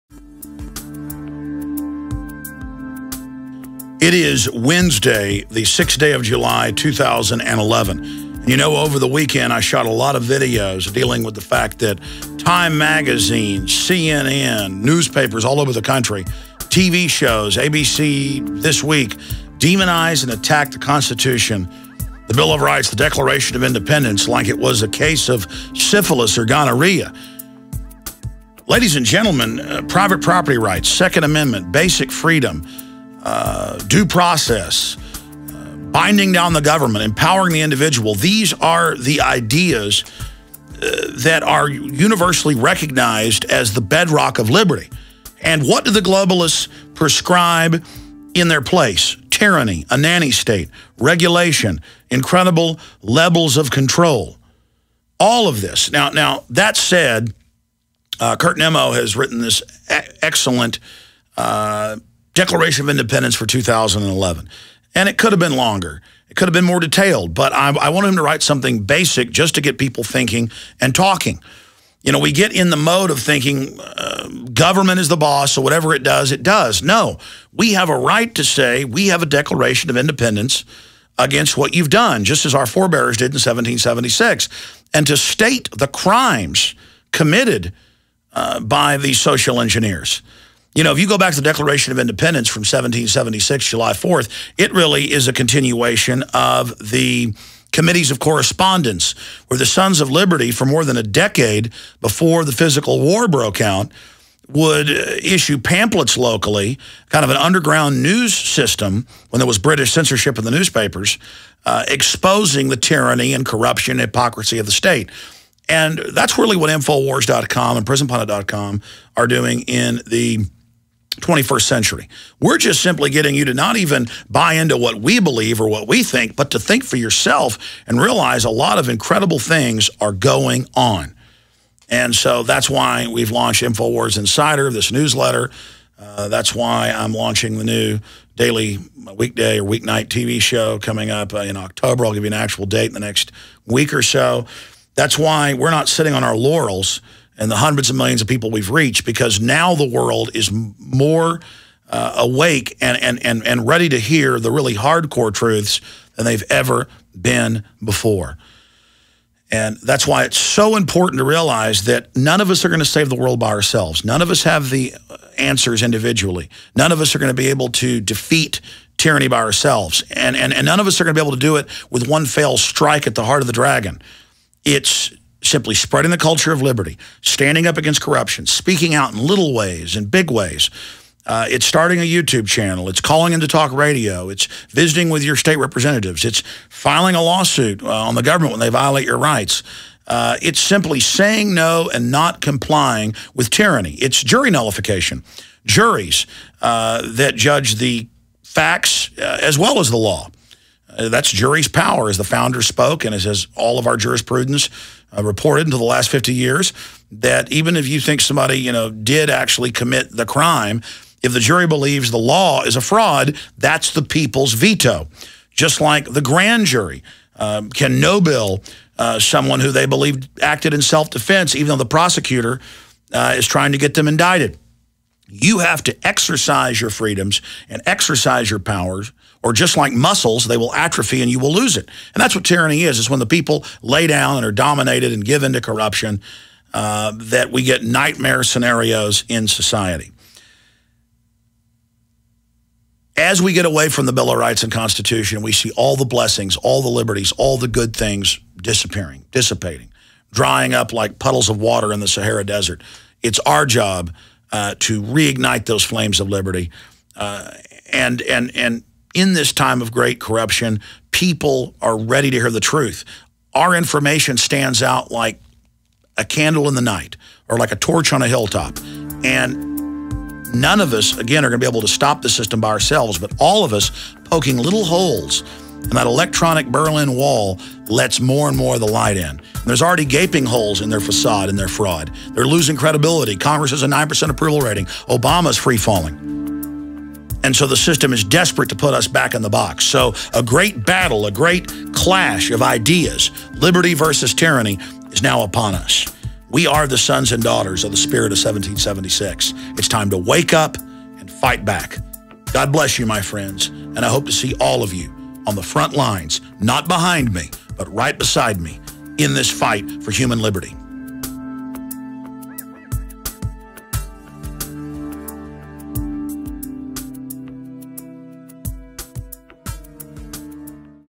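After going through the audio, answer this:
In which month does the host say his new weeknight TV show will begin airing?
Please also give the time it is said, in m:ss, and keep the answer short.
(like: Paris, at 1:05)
October, at 2:21.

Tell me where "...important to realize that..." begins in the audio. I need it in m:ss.
2:40.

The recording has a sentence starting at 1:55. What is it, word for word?
And that's really what Infowars.com and PrisonPlanet.com are doing in the 21st century.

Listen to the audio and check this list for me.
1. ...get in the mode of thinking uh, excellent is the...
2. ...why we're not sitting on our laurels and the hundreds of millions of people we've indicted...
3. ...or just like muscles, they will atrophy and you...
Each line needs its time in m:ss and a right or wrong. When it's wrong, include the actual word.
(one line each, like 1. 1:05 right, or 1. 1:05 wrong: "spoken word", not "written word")
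1. 1:12 wrong: "government", not "excellent"
2. 2:25 wrong: "reached", not "indicted"
3. 3:49 right.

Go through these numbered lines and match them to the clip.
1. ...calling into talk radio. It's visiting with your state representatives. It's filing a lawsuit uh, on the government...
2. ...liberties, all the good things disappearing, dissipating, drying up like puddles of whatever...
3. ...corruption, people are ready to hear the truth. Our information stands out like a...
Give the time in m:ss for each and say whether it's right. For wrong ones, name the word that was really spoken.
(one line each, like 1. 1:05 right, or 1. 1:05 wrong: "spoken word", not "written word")
1. 3:03 right
2. 4:06 wrong: "water", not "whatever"
3. 4:20 right.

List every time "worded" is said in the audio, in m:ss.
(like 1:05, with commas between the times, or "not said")
not said.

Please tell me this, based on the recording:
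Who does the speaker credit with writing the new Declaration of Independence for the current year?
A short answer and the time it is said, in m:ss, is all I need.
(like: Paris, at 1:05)
Kurt Nimmo, at 0:58.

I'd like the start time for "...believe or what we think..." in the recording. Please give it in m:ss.
2:05.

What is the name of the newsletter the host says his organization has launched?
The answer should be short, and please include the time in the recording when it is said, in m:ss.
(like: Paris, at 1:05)
InfoWars Insider, at 2:13.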